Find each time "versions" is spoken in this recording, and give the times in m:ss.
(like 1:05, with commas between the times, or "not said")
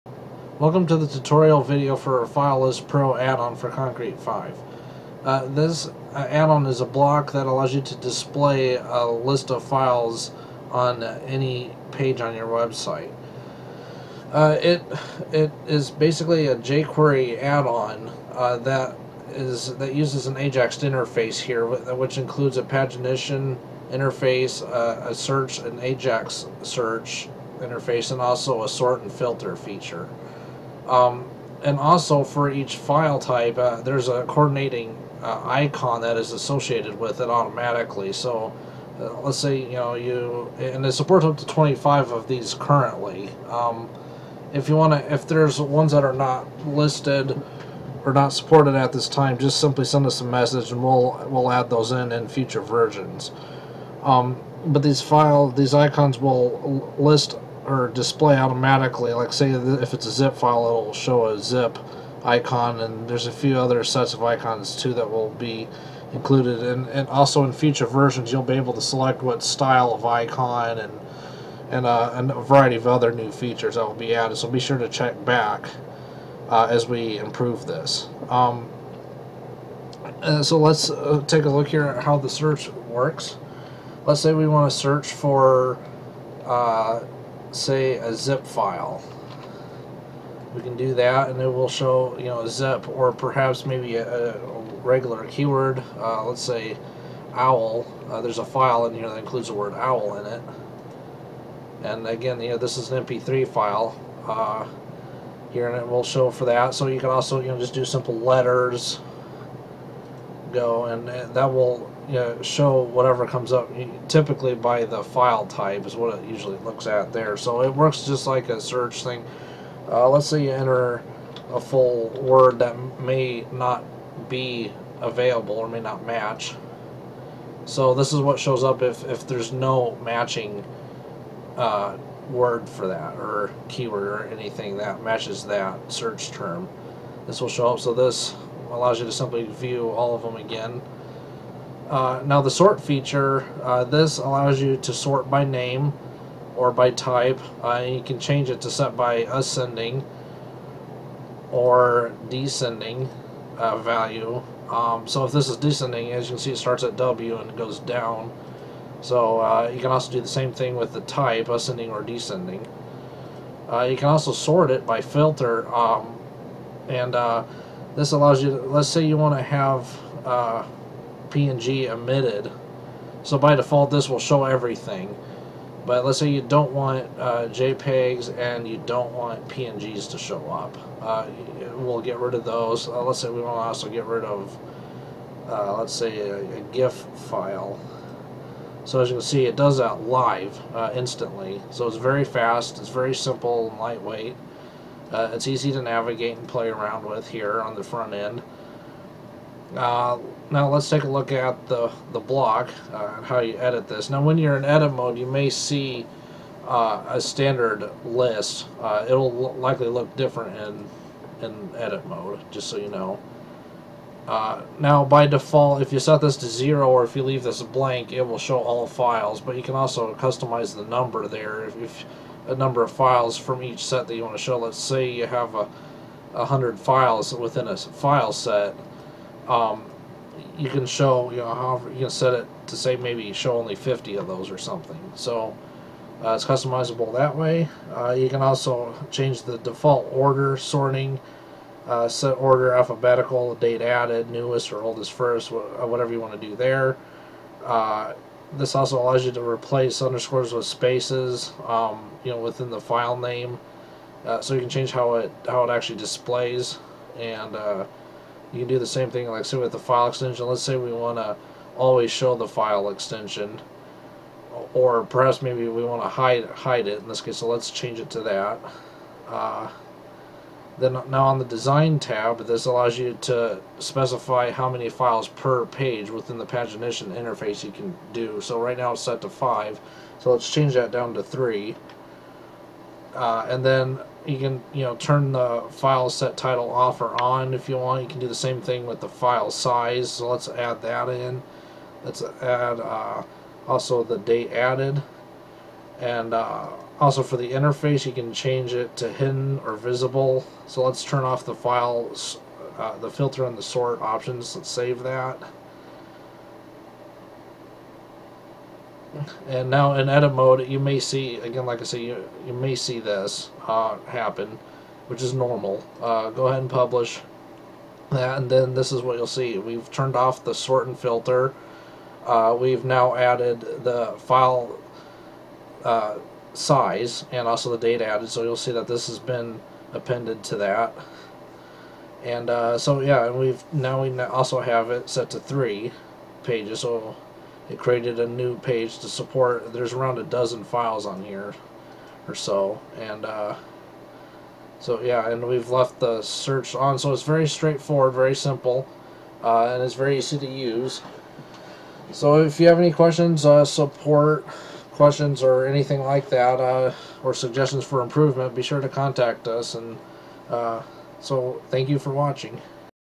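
0:52, 1:07.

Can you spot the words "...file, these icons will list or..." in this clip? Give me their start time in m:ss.
0:55.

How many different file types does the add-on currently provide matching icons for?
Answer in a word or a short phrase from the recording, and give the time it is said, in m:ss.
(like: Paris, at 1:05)
25, at 0:41.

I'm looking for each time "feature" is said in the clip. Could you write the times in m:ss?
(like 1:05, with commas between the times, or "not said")
0:29, 1:13, 2:22.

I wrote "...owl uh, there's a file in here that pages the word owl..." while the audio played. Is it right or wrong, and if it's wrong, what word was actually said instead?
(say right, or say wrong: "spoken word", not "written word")
wrong: "includes", not "pages".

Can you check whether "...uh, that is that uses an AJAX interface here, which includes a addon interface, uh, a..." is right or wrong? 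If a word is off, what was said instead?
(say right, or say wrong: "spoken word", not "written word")
wrong: "pagination", not "addon".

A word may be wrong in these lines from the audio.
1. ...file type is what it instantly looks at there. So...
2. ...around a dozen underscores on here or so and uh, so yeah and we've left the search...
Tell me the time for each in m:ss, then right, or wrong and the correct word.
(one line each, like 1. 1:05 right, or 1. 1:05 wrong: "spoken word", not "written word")
1. 1:55 wrong: "usually", not "instantly"
2. 5:39 wrong: "files", not "underscores".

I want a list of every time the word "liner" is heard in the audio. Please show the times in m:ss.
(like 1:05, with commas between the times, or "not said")
not said.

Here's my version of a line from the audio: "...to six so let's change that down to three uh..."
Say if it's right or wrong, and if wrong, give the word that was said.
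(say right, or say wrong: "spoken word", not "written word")
wrong: "five", not "six".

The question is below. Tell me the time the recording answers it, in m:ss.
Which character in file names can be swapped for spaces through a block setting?
4:10.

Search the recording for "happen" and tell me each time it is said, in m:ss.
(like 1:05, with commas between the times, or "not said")
5:14.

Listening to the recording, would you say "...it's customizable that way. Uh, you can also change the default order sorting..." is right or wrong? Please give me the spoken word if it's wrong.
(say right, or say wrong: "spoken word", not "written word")
right.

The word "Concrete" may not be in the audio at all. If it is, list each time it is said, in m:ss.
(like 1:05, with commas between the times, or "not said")
0:03.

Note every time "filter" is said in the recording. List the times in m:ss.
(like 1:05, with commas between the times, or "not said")
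0:29, 2:45, 5:03, 5:20.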